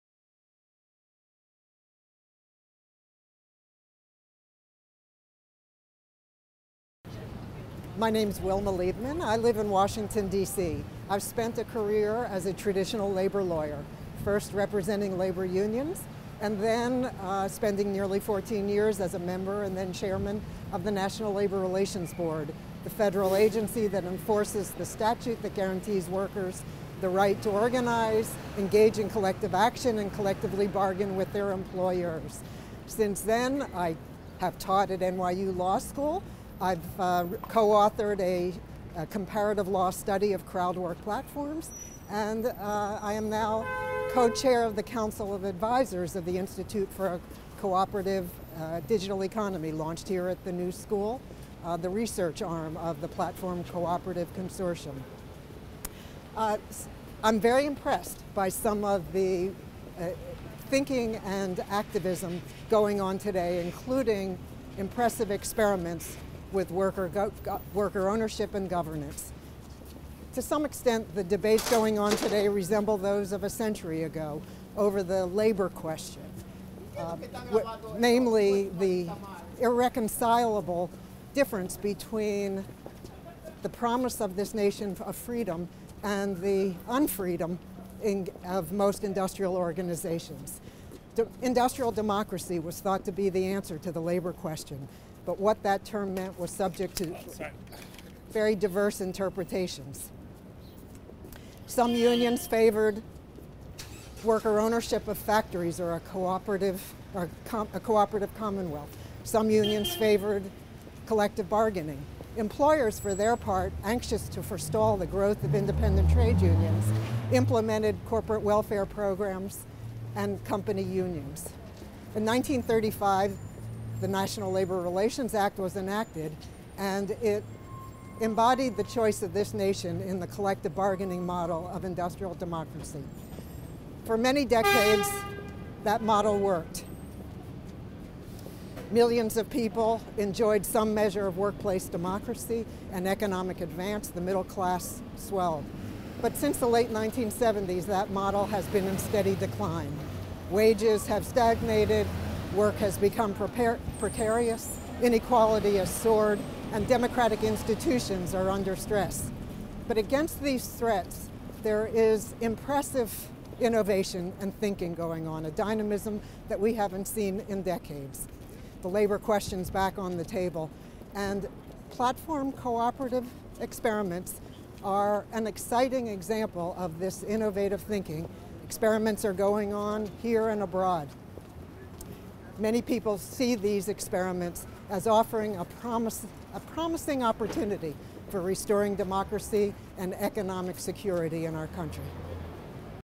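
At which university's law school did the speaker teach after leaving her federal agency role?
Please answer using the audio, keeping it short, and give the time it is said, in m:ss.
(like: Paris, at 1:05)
NYU, at 0:35.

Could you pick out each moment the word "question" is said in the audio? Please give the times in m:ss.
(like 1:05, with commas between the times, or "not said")
1:15, 1:34, 2:49.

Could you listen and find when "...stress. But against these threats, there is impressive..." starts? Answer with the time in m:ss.
2:38.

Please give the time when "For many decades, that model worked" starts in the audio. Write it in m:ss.
2:14.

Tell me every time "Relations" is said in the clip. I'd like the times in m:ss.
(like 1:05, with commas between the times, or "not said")
0:21, 2:04.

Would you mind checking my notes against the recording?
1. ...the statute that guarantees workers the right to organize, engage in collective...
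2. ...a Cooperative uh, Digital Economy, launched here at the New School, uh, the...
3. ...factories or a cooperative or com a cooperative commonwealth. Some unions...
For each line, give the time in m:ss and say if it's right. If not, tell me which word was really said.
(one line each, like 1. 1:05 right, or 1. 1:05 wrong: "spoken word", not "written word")
1. 0:24 right
2. 0:47 right
3. 1:45 right.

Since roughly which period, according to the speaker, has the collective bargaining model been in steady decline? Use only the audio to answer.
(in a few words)
late 1970s.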